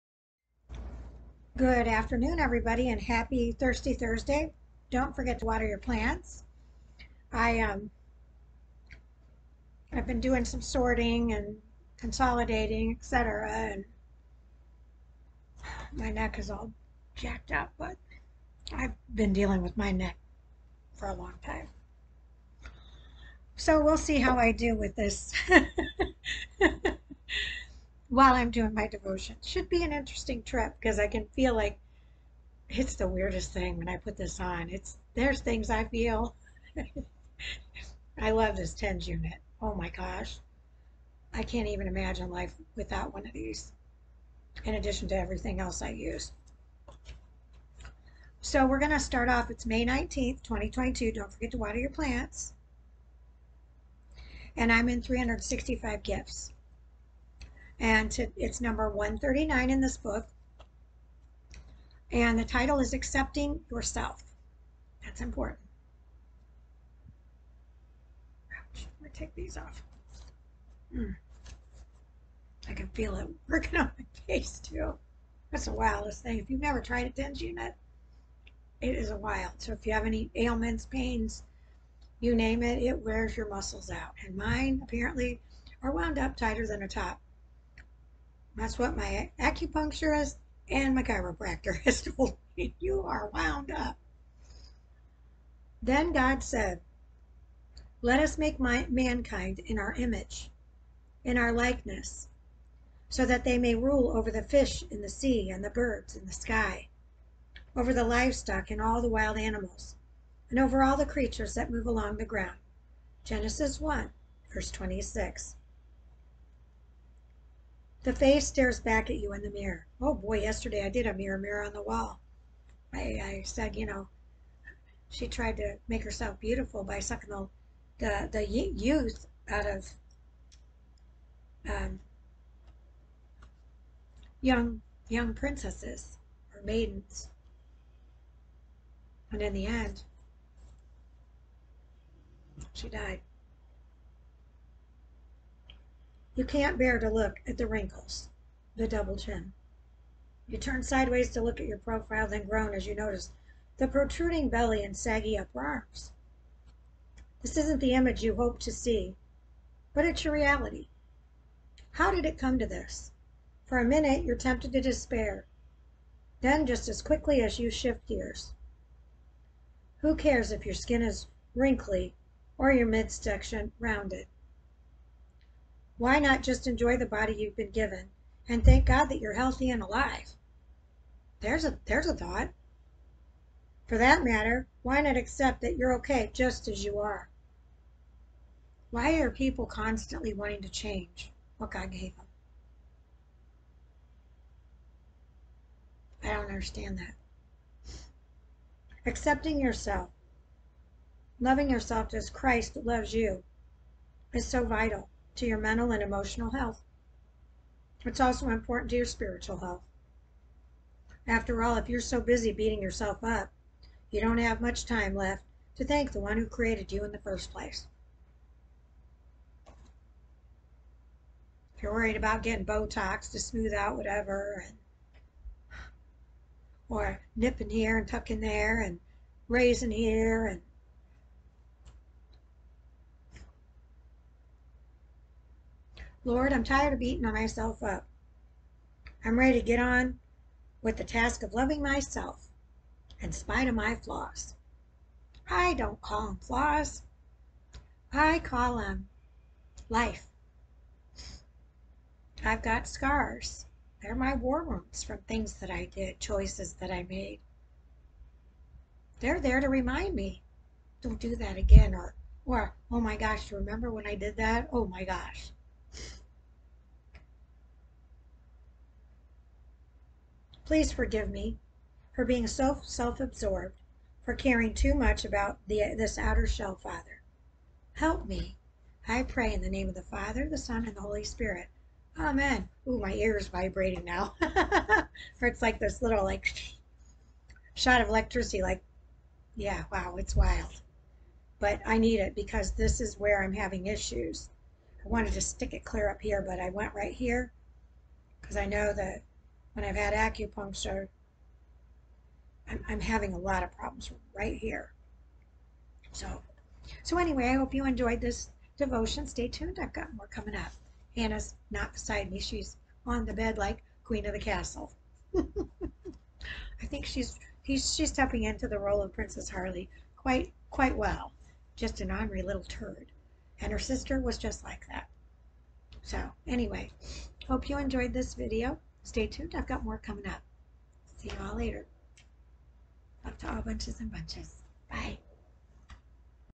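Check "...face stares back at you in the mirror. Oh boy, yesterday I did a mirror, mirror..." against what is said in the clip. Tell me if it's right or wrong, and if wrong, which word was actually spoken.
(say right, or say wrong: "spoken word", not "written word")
right.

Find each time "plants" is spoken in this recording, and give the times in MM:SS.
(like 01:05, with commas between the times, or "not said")
00:05, 00:51.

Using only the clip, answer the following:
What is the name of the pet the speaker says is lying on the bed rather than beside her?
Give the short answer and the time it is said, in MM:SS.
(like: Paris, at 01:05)
Hannah, at 05:11.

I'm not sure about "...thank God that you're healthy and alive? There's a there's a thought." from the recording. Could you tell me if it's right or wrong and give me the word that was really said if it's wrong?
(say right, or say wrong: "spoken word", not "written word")
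right.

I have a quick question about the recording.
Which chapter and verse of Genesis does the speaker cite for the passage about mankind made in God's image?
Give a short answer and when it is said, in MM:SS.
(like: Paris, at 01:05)
Genesis 1:26, at 01:53.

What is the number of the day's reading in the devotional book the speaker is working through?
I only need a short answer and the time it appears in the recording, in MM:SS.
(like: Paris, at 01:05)
139, at 00:58.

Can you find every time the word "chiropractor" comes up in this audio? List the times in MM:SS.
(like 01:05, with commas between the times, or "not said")
01:31.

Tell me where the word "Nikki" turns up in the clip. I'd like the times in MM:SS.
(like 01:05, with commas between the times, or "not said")
not said.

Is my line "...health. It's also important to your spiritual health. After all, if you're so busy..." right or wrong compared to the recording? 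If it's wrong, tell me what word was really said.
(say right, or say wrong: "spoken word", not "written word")
right.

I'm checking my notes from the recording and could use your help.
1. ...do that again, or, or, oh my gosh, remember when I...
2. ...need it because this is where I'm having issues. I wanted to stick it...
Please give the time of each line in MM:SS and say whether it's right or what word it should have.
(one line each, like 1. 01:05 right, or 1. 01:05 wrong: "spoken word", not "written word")
1. 04:21 right
2. 04:51 right.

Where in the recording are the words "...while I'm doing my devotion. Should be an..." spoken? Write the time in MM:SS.
00:28.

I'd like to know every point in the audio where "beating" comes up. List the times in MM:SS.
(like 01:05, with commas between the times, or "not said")
03:32, 03:56.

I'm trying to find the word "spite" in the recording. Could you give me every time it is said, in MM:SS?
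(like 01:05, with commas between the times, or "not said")
04:03.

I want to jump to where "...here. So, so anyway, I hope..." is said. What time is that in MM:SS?
05:04.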